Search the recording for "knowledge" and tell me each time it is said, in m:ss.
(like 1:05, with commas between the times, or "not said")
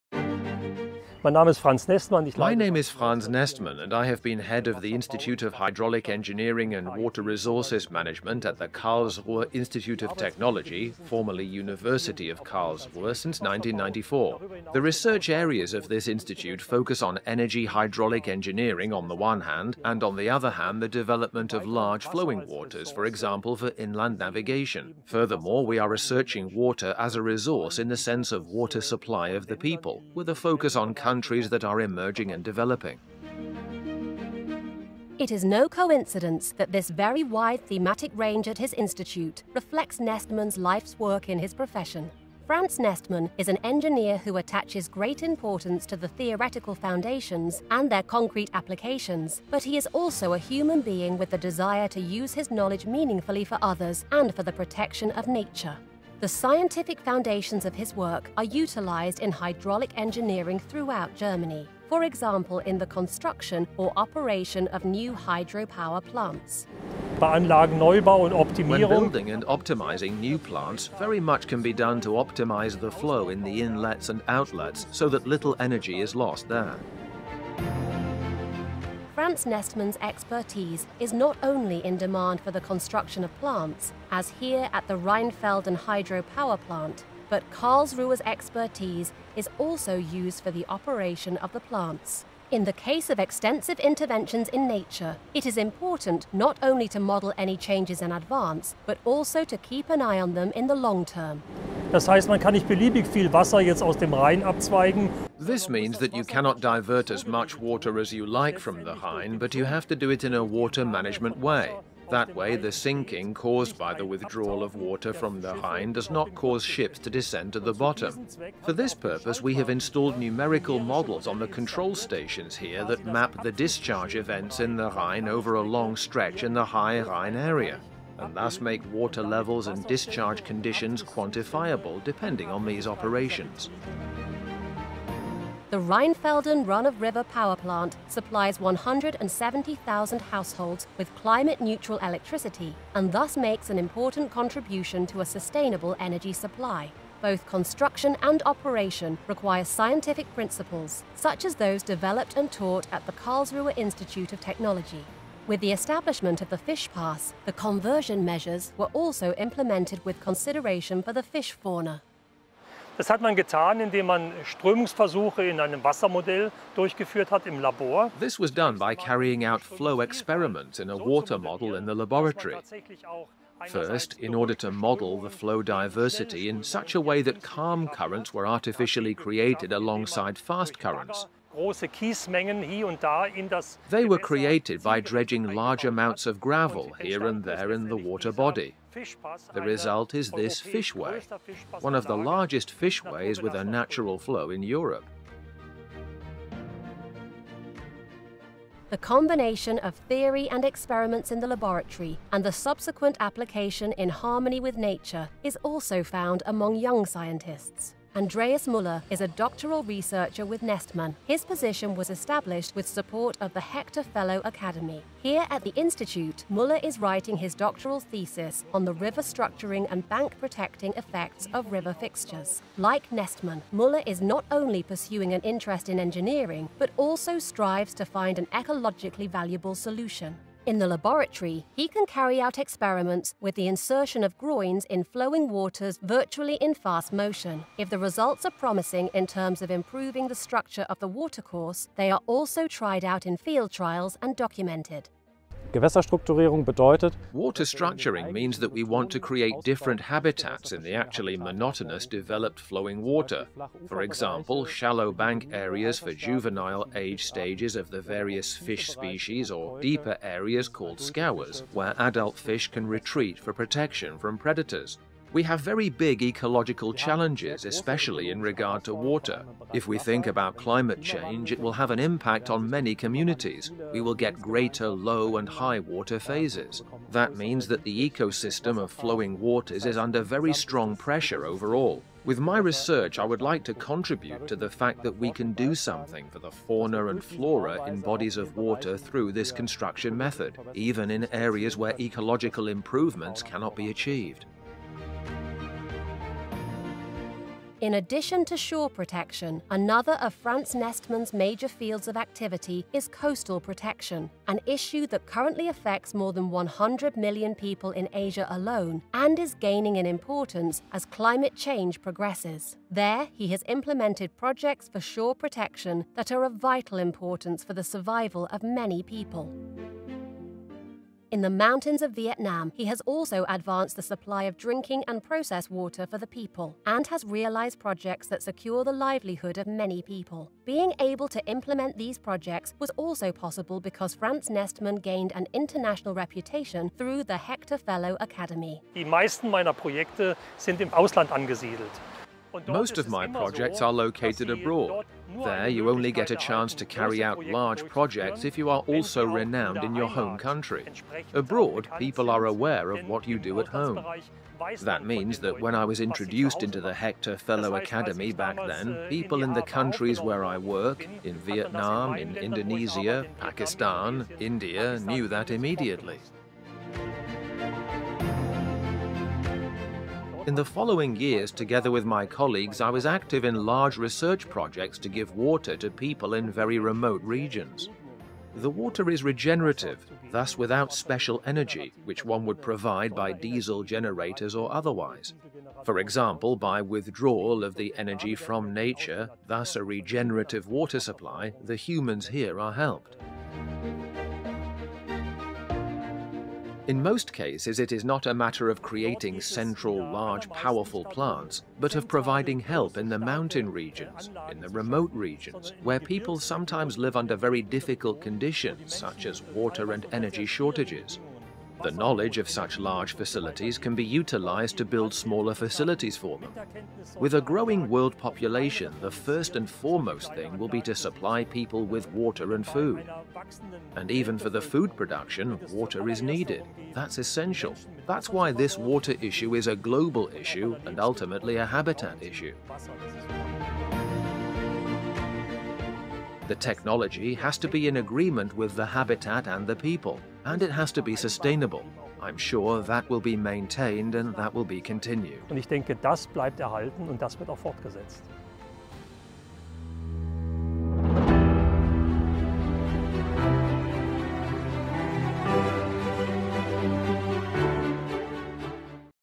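0:52, 6:51.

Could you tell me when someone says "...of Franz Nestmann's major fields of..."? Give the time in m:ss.
5:00.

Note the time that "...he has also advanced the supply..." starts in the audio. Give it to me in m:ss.
5:22.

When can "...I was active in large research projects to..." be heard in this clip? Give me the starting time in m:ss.
6:12.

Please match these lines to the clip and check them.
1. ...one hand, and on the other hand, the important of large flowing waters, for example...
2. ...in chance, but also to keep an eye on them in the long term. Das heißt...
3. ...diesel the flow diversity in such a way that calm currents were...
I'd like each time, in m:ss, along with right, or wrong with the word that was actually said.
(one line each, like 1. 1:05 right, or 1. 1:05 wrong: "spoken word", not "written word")
1. 0:19 wrong: "development", not "important"
2. 1:38 wrong: "advance", not "chance"
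3. 2:54 wrong: "model", not "diesel".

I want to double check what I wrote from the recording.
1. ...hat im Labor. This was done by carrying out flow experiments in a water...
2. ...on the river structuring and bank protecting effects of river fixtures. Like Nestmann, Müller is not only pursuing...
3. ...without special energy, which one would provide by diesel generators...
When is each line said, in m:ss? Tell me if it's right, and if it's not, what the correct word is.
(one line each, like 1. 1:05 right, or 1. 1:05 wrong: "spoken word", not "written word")
1. 2:47 right
2. 3:38 right
3. 6:20 right.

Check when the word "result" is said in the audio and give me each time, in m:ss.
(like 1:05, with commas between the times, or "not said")
3:09, 3:57.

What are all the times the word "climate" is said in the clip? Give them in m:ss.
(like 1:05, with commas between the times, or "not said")
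2:21, 4:30, 5:11.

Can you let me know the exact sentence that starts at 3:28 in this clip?
Andreas Müller is a doctoral researcher with Nestmann.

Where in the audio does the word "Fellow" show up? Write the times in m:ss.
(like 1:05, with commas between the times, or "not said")
3:34, 5:37, 5:57.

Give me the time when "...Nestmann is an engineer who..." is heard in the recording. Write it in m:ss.
0:42.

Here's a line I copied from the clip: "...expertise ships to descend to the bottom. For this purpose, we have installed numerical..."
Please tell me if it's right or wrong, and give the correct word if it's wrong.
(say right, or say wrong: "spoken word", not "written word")
wrong: "cause", not "expertise".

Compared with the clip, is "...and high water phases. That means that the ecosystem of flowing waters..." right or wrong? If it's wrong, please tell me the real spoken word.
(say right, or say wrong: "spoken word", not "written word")
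right.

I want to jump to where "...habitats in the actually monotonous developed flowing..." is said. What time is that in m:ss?
4:10.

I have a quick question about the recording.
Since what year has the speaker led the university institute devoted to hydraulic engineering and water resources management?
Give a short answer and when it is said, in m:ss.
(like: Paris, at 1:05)
1994, at 0:13.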